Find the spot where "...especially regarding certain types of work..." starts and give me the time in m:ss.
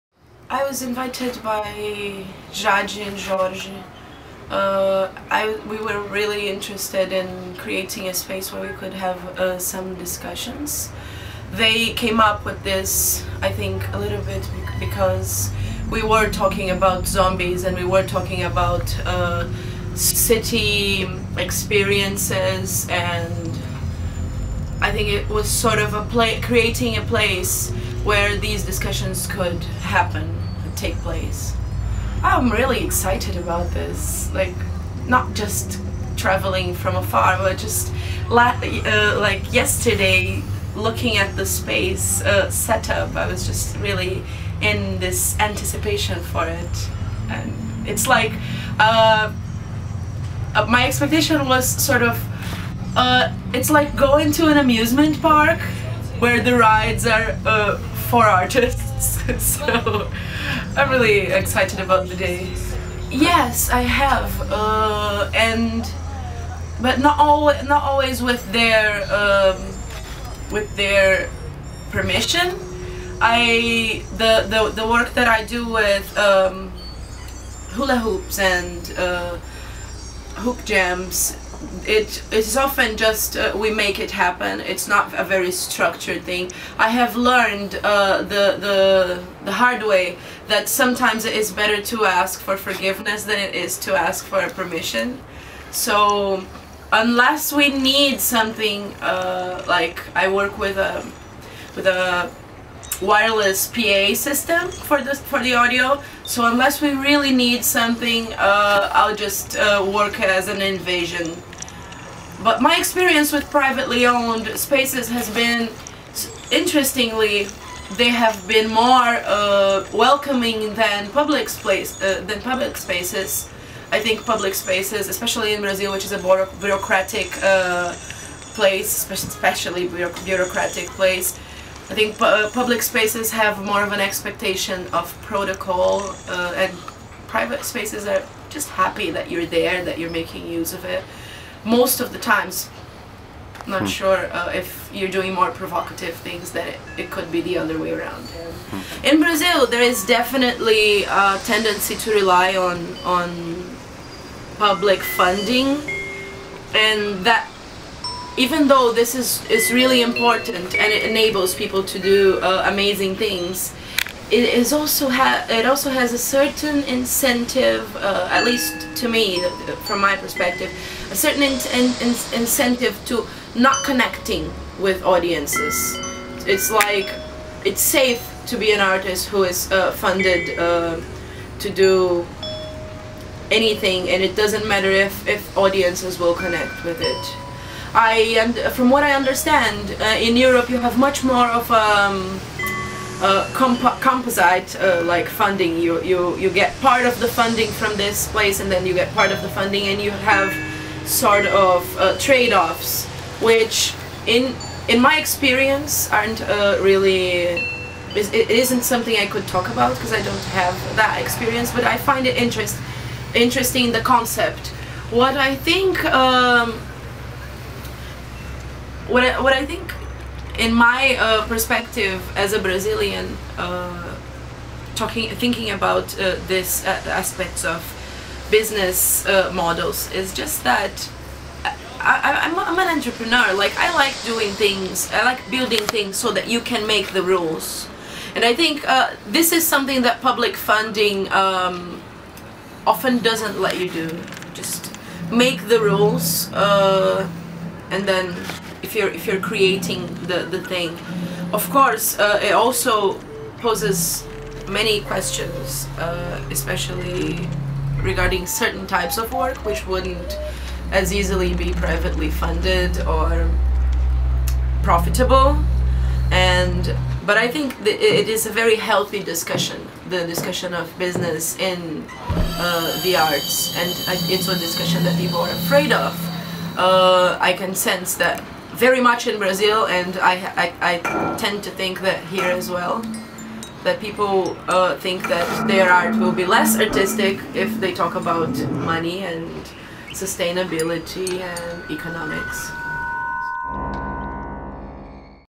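4:16.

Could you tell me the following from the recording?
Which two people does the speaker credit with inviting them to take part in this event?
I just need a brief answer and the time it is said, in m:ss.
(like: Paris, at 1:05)
Jade and Jorge, at 0:02.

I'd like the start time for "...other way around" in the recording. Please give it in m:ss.
2:27.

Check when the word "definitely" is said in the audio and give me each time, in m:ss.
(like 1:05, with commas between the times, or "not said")
2:30.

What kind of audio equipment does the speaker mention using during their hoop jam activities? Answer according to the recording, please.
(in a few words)
wireless PA system.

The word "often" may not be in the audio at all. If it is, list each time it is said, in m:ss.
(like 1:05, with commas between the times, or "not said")
1:22, 4:02.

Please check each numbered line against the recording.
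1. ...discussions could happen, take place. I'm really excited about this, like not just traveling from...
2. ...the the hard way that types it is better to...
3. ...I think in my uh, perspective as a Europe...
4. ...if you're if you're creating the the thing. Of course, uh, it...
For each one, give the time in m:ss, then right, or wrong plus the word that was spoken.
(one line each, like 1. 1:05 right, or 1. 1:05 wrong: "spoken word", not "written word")
1. 0:28 right
2. 1:28 wrong: "sometimes", not "types"
3. 3:39 wrong: "Brazilian", not "Europe"
4. 4:08 right.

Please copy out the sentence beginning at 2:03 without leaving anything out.
I think public spaces, especially in Brazil, which is a bureaucratic uh, place, especially bureaucratic place.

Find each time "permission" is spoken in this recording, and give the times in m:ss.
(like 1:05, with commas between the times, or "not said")
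1:11, 1:34.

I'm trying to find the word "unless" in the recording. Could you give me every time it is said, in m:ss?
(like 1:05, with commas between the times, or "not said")
1:36, 1:46.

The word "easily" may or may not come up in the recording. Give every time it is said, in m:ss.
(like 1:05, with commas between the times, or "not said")
4:21.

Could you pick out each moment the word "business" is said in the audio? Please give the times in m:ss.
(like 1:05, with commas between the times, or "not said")
3:48, 4:30.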